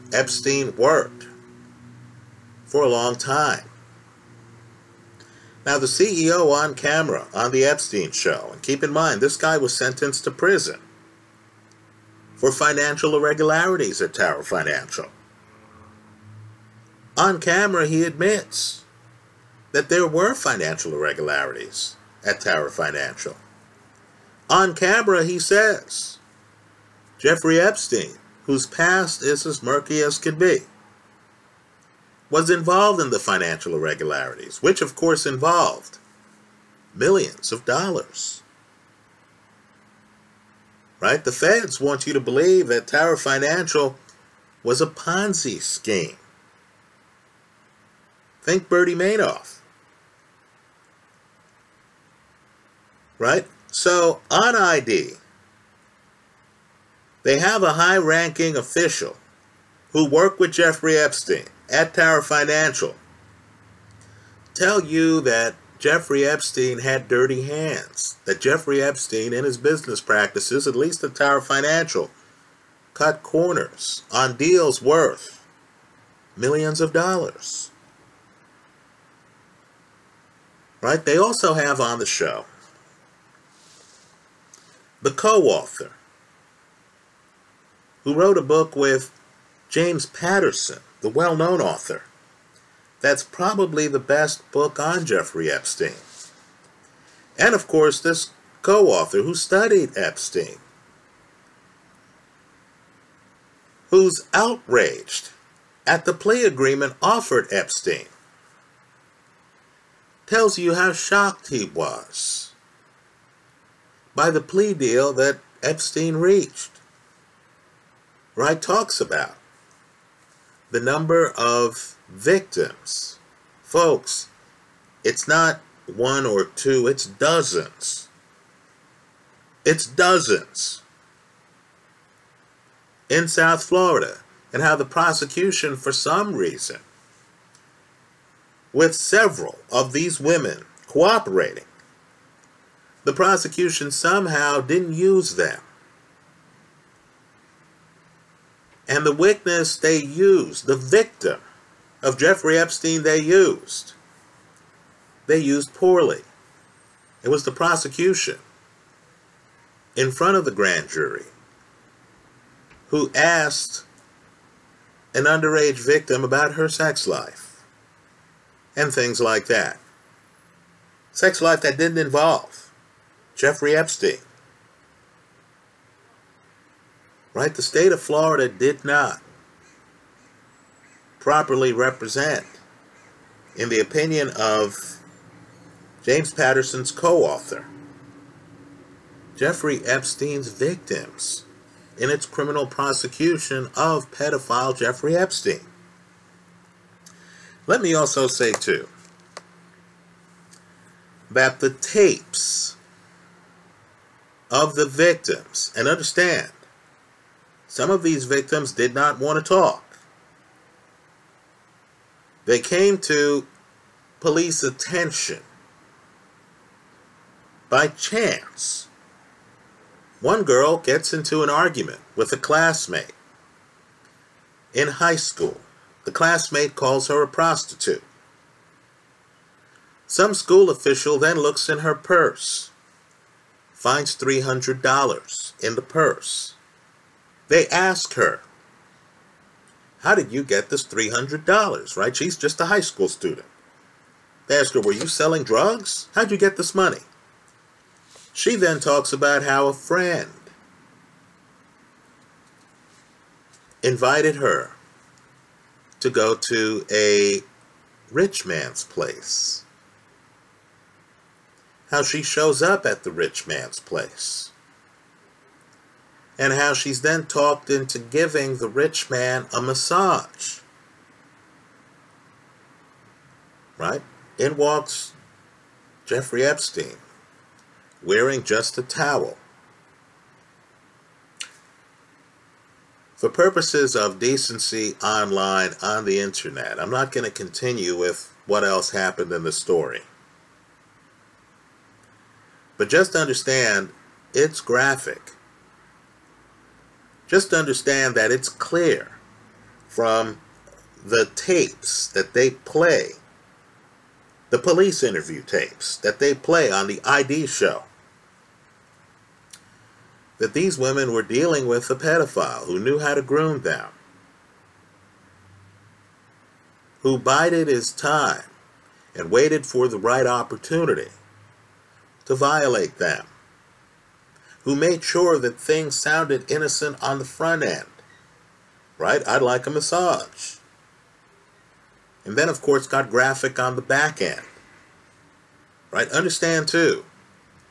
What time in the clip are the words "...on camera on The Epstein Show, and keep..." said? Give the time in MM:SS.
00:06.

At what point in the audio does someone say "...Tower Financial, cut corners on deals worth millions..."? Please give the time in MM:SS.
01:11.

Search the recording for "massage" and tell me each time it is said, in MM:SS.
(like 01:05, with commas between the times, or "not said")
04:29, 05:29.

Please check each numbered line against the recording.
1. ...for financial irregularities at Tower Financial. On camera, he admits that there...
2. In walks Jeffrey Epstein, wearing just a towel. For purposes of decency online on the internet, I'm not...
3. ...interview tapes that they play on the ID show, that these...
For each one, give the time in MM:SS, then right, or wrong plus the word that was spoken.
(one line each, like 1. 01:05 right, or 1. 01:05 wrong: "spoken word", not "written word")
1. 00:12 right
2. 04:34 right
3. 05:05 right.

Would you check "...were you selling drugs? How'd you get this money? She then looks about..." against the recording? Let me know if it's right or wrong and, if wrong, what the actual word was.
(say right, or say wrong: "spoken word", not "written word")
wrong: "talks", not "looks".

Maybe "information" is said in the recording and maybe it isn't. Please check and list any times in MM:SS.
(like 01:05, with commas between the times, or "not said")
not said.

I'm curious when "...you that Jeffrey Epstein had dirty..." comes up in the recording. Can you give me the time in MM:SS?
01:04.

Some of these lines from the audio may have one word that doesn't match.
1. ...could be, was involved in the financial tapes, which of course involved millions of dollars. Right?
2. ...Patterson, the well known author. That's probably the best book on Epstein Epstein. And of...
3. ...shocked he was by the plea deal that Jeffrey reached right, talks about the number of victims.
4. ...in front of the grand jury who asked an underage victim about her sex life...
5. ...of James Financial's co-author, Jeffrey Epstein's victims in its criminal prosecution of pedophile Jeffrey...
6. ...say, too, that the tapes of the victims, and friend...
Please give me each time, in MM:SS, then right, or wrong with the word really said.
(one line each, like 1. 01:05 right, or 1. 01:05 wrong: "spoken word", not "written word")
1. 00:30 wrong: "irregularities", not "tapes"
2. 01:30 wrong: "Jeffrey", not "Epstein"
3. 01:50 wrong: "Epstein", not "Jeffrey"
4. 02:39 right
5. 03:04 wrong: "Patterson", not "Financial"
6. 03:18 wrong: "understand", not "friend".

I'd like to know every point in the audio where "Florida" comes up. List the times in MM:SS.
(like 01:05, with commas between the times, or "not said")
02:13, 02:58.